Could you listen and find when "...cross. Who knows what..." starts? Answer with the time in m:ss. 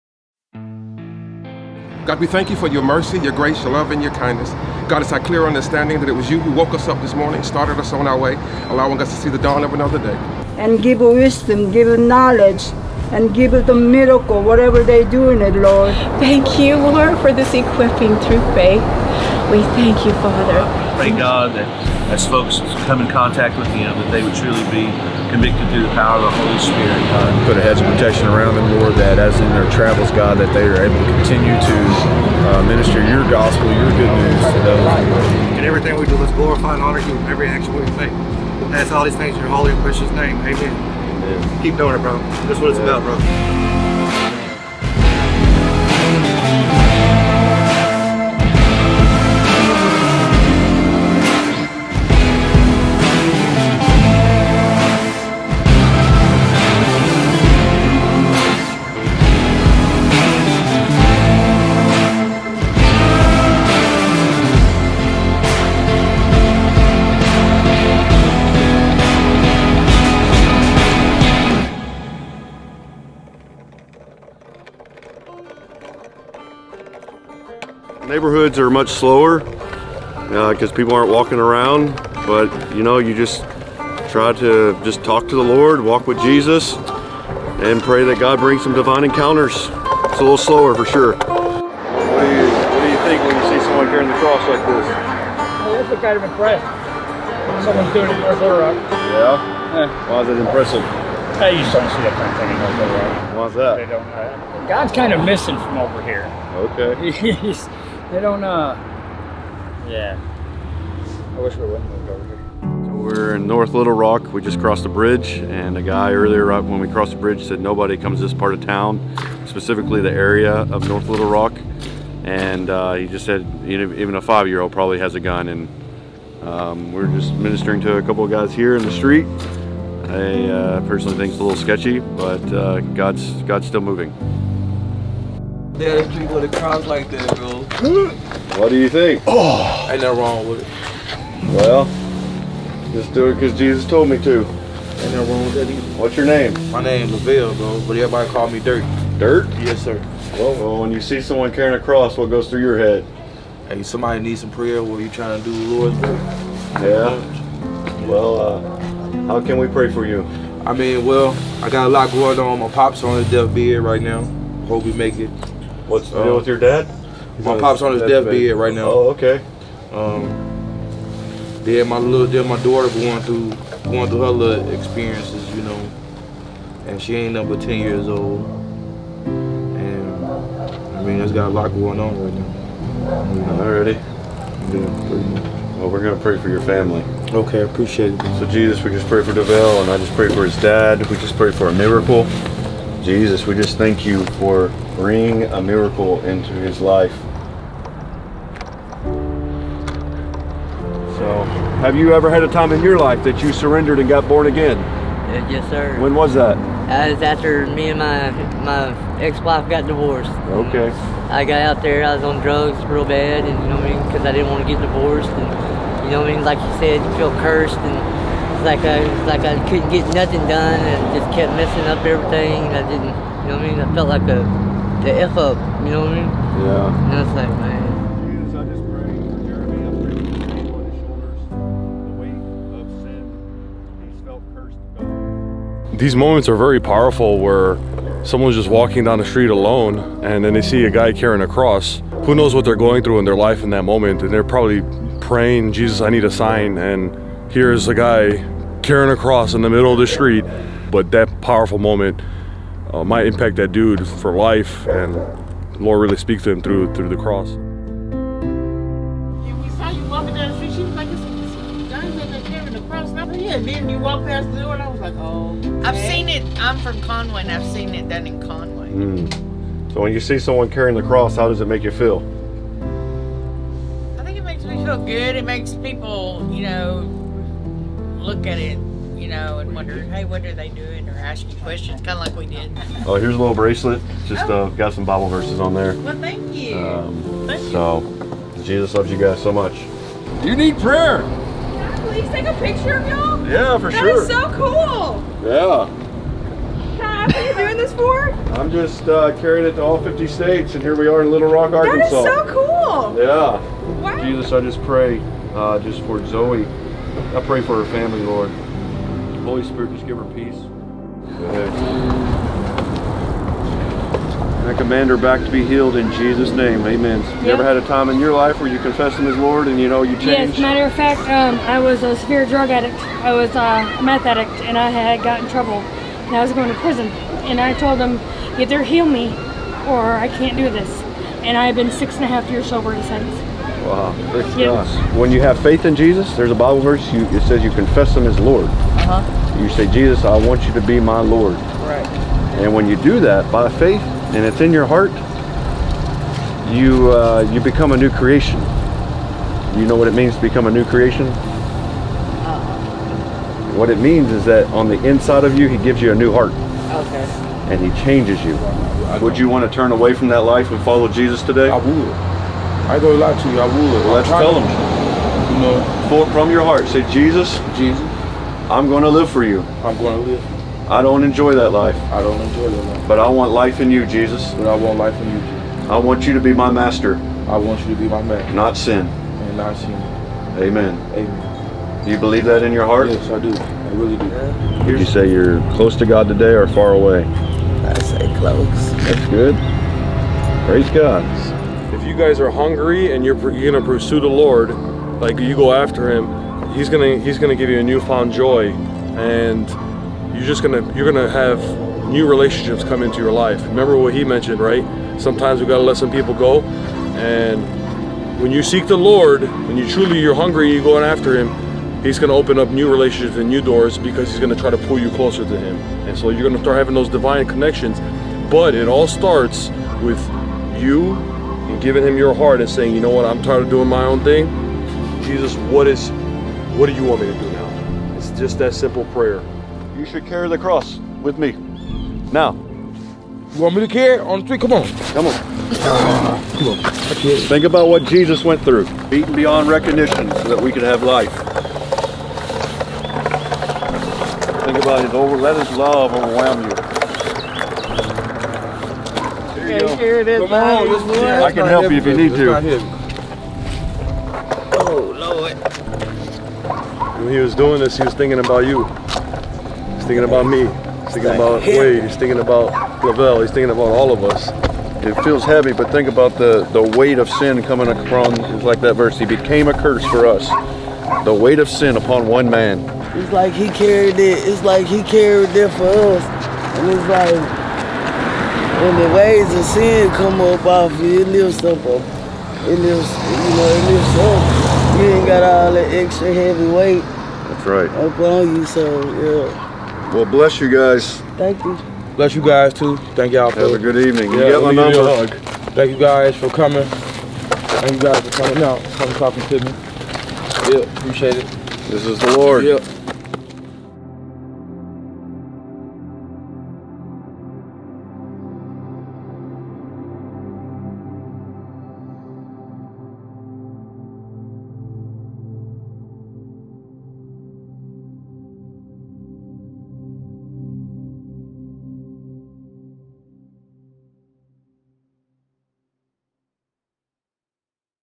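4:01.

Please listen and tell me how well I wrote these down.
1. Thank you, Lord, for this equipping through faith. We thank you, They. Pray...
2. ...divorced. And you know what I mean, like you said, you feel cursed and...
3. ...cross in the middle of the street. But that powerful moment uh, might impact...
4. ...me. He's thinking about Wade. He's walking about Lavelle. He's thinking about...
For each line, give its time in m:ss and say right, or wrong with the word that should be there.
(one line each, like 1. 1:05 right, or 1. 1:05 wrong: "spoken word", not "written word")
1. 0:16 wrong: "Father", not "They"
2. 3:34 right
3. 4:09 right
4. 7:40 wrong: "thinking", not "walking".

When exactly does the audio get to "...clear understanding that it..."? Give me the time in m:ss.
0:05.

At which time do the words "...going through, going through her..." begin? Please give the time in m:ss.
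2:52.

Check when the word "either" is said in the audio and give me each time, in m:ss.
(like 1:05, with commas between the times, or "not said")
2:25, 5:28.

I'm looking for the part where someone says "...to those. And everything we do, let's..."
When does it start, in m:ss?
0:34.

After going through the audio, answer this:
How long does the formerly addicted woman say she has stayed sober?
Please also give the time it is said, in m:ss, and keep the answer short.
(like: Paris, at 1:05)
6 and a half years, at 5:31.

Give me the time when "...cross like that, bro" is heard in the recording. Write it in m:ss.
2:16.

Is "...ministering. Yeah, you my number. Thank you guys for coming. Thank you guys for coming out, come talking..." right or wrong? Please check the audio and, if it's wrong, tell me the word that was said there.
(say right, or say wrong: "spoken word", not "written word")
wrong: "evening", not "ministering".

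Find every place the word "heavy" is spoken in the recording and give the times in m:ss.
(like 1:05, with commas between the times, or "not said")
7:45, 8:06.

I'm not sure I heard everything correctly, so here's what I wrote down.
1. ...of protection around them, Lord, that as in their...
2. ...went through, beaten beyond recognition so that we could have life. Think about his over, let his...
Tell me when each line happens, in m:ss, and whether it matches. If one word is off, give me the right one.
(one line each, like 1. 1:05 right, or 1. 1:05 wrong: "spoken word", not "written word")
1. 0:27 right
2. 7:18 right.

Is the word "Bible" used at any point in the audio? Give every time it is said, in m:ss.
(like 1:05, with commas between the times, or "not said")
4:45, 5:36.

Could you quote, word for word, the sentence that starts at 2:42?
My pops on his deathbed right now.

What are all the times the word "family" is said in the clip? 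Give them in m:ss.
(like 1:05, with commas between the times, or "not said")
3:06, 5:07.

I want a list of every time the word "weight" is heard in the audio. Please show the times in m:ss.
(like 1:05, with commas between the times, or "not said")
7:46, 7:51, 8:06.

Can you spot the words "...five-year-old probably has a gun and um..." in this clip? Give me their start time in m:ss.
2:04.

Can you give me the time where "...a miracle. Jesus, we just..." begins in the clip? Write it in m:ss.
3:11.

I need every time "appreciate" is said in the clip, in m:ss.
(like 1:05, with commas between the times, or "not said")
3:07, 8:20.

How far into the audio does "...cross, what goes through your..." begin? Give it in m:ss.
2:31.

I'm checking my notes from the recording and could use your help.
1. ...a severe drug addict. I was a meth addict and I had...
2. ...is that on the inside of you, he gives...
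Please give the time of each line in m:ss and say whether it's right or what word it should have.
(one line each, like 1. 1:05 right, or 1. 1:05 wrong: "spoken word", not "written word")
1. 5:22 right
2. 5:54 right.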